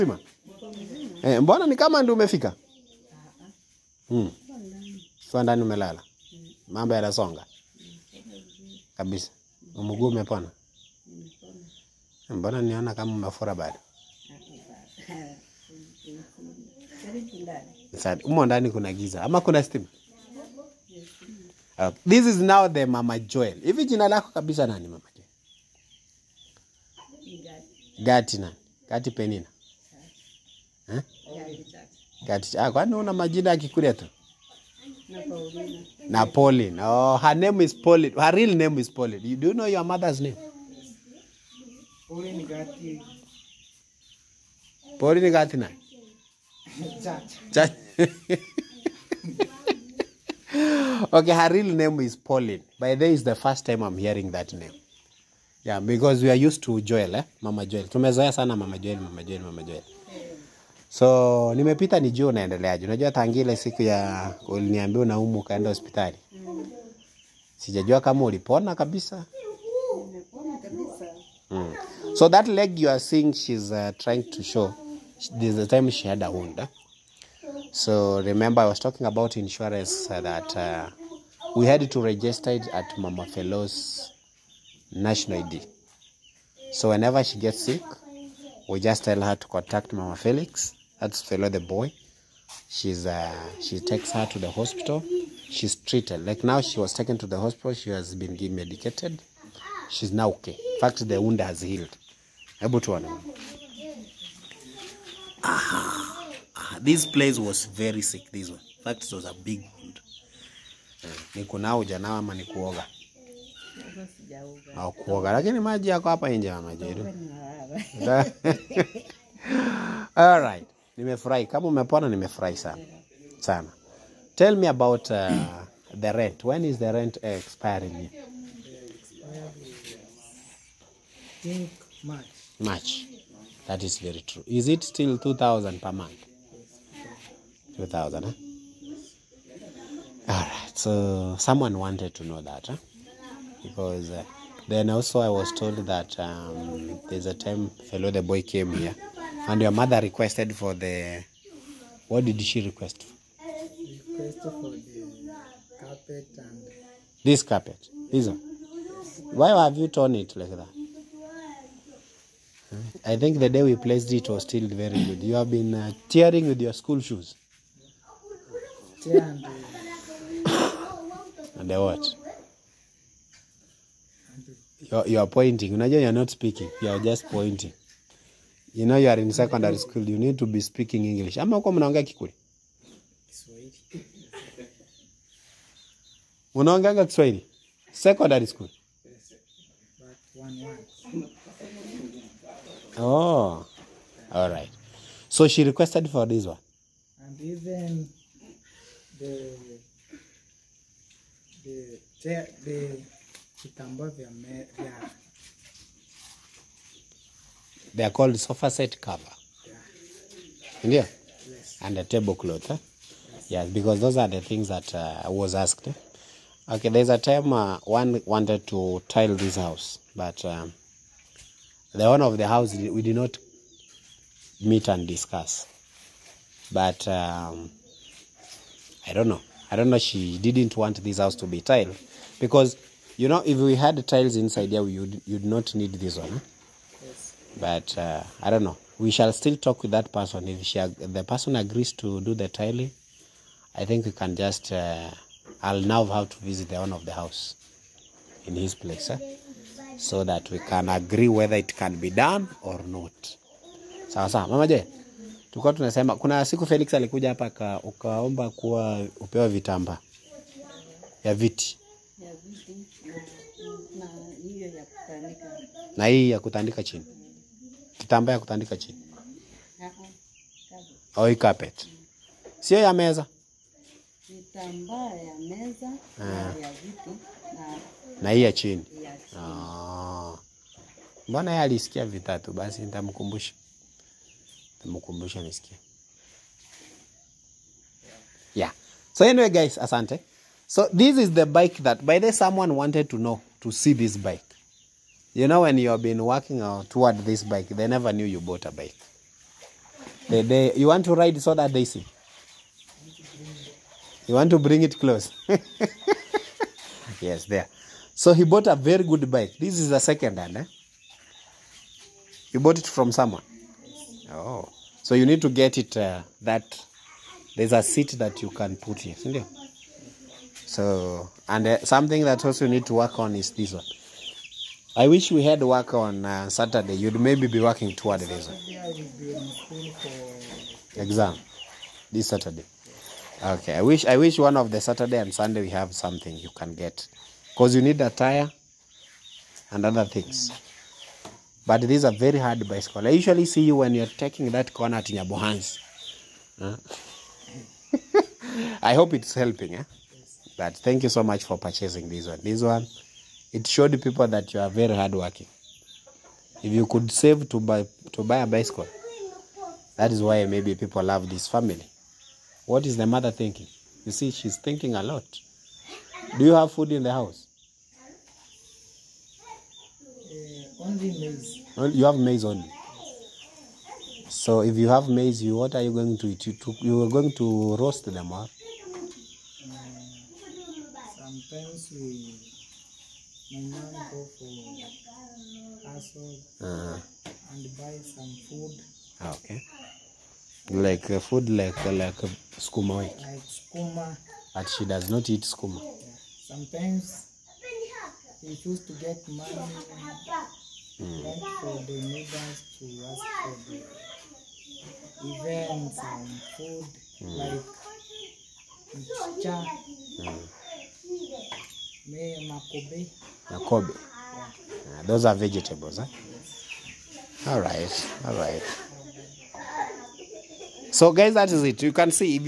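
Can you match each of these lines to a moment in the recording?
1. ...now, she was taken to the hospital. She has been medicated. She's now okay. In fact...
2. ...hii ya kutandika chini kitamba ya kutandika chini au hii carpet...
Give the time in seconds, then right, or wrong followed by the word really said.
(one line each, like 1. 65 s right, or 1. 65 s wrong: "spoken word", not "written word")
1. 96 s right
2. 266 s right.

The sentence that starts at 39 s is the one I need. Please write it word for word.
You, do you know your mother's name?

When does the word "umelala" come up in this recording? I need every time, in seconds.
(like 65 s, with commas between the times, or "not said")
5 s.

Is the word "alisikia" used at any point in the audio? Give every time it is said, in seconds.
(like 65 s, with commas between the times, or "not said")
281 s.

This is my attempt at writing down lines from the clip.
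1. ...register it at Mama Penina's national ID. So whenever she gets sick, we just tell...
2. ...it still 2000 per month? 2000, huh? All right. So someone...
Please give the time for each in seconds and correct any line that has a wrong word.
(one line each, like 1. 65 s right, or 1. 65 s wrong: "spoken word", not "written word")
1. 82 s wrong: "Fellow", not "Penina"
2. 134 s right.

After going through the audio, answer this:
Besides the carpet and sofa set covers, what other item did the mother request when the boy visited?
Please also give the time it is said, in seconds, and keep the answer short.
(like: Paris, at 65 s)
Tablecloth, at 212 s.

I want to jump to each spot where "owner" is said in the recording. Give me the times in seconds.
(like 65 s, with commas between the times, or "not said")
222 s, 246 s.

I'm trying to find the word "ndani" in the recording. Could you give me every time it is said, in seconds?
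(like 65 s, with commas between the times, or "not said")
5 s, 18 s.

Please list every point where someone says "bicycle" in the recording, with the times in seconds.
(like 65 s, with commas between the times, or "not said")
342 s, 358 s.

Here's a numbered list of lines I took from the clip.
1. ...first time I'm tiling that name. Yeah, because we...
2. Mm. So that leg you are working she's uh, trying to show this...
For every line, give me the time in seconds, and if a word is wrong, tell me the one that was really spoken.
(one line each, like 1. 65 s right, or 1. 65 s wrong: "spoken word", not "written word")
1. 53 s wrong: "hearing", not "tiling"
2. 71 s wrong: "seeing", not "working".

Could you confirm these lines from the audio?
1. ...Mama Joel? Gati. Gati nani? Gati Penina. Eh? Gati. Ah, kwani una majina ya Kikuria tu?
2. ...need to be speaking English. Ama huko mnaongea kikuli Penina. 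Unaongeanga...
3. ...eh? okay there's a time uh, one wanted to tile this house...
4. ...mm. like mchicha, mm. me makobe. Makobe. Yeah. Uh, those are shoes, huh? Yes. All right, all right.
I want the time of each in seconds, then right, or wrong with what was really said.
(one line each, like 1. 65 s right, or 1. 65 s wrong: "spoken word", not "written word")
1. 24 s right
2. 180 s wrong: "Kiswahili", not "Penina"
3. 215 s right
4. 407 s wrong: "vegetables", not "shoes".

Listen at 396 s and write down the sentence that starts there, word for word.
Sometimes we choose to get money mm.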